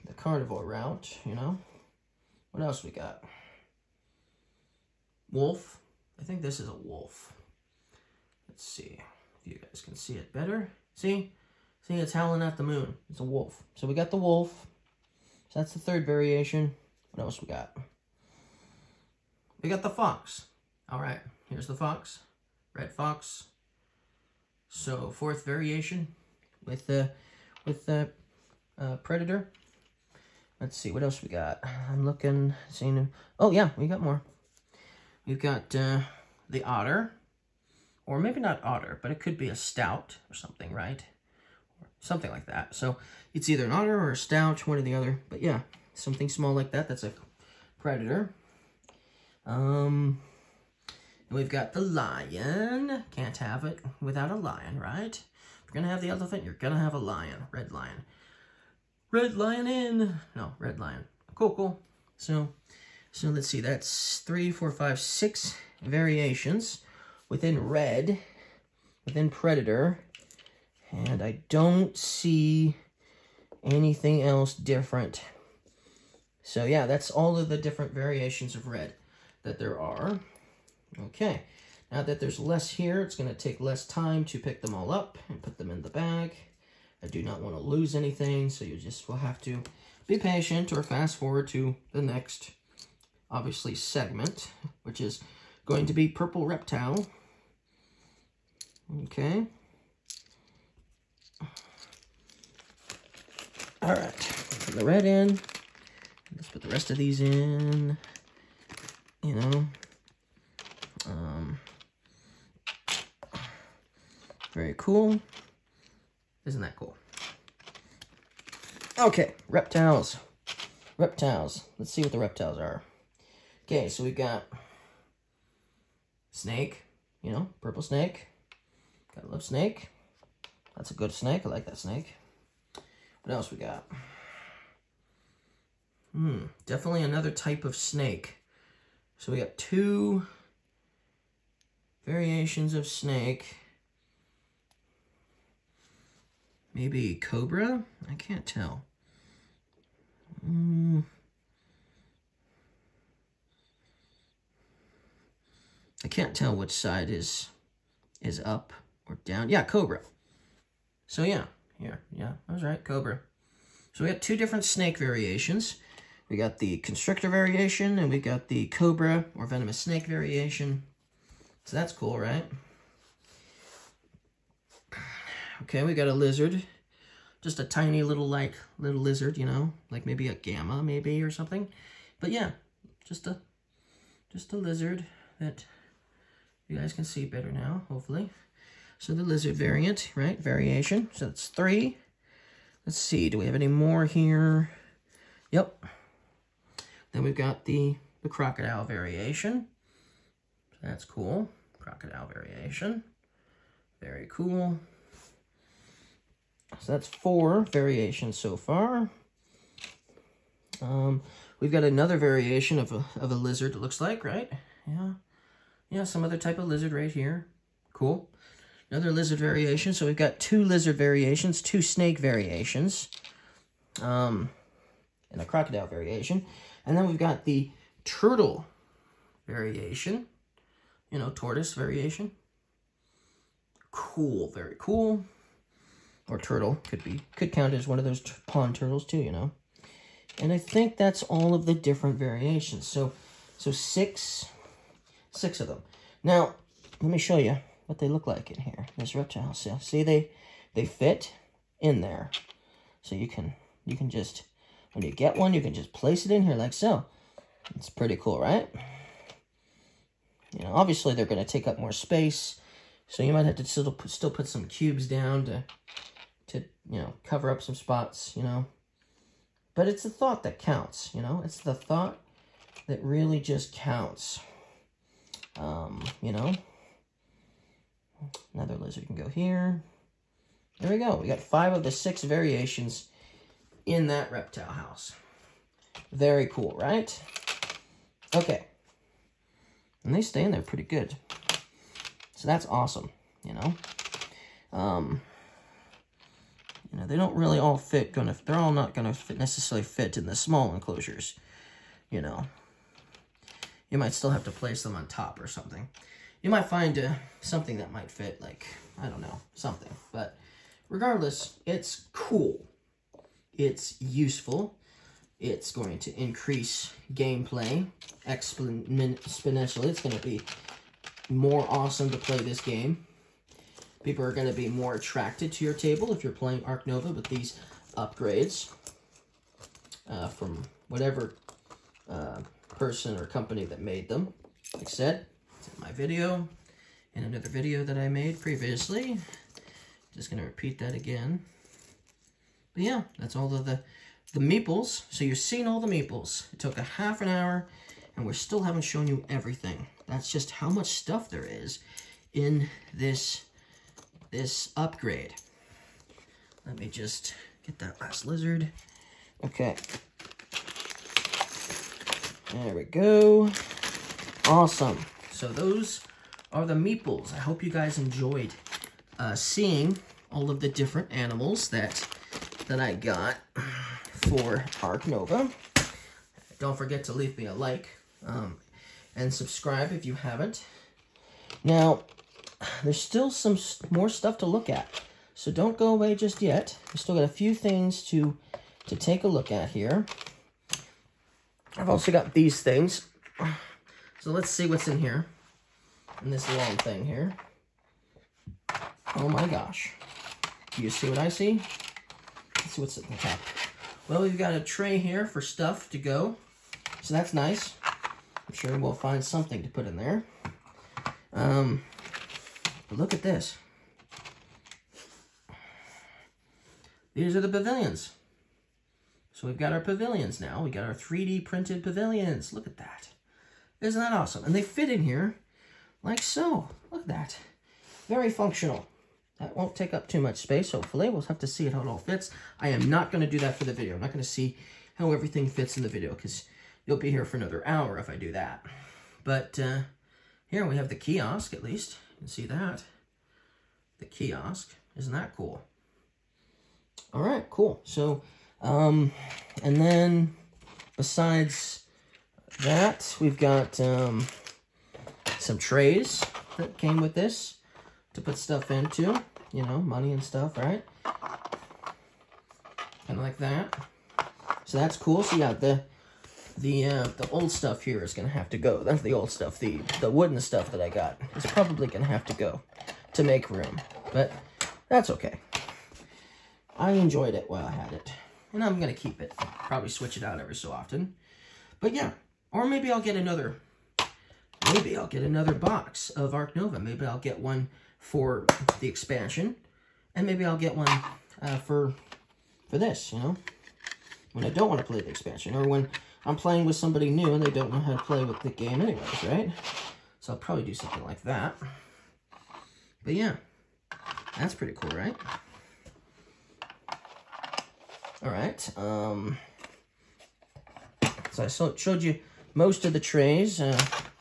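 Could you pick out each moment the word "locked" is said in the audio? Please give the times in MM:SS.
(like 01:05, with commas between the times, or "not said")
not said.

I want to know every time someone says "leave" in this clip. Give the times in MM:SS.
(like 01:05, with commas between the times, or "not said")
06:17.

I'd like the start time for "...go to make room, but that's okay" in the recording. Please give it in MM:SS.
07:52.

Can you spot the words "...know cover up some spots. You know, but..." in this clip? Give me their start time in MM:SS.
04:27.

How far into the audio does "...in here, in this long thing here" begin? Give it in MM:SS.
06:34.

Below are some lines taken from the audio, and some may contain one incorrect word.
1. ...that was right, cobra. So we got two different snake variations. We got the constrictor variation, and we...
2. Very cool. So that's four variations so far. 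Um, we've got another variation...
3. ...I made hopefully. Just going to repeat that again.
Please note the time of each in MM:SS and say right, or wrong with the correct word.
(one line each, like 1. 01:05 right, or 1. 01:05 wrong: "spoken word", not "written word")
1. 02:42 right
2. 03:24 right
3. 05:37 wrong: "previously", not "hopefully".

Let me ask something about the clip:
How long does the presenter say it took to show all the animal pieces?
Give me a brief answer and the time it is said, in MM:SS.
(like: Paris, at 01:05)
Half an hour, at 05:46.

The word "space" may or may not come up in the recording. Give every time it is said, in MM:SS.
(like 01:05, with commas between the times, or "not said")
04:21, 07:10.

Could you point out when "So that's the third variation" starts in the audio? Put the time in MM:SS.
00:15.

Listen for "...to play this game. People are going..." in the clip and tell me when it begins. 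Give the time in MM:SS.
05:22.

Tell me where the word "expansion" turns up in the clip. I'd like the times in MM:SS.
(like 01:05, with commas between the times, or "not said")
08:08, 08:15.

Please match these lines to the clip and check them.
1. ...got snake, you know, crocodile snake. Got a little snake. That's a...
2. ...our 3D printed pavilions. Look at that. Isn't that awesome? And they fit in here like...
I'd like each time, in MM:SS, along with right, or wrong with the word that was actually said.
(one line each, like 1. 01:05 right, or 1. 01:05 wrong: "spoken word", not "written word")
1. 02:04 wrong: "purple", not "crocodile"
2. 07:00 right.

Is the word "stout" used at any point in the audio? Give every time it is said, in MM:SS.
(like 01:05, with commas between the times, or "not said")
00:39.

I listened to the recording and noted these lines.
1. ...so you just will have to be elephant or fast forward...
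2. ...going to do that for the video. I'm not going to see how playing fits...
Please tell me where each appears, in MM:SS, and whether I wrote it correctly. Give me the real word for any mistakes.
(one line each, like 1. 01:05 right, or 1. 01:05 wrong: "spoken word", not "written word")
1. 01:28 wrong: "patient", not "elephant"
2. 07:13 wrong: "everything", not "playing".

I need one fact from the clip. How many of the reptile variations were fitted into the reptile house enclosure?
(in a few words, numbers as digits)
5.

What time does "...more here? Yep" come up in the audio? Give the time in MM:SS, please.
03:13.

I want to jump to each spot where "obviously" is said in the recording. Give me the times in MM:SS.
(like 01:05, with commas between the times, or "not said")
01:33, 04:20.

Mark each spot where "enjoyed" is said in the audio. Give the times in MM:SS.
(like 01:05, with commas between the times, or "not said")
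06:07, 07:56.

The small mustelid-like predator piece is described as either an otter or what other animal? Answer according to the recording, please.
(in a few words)
Stoat.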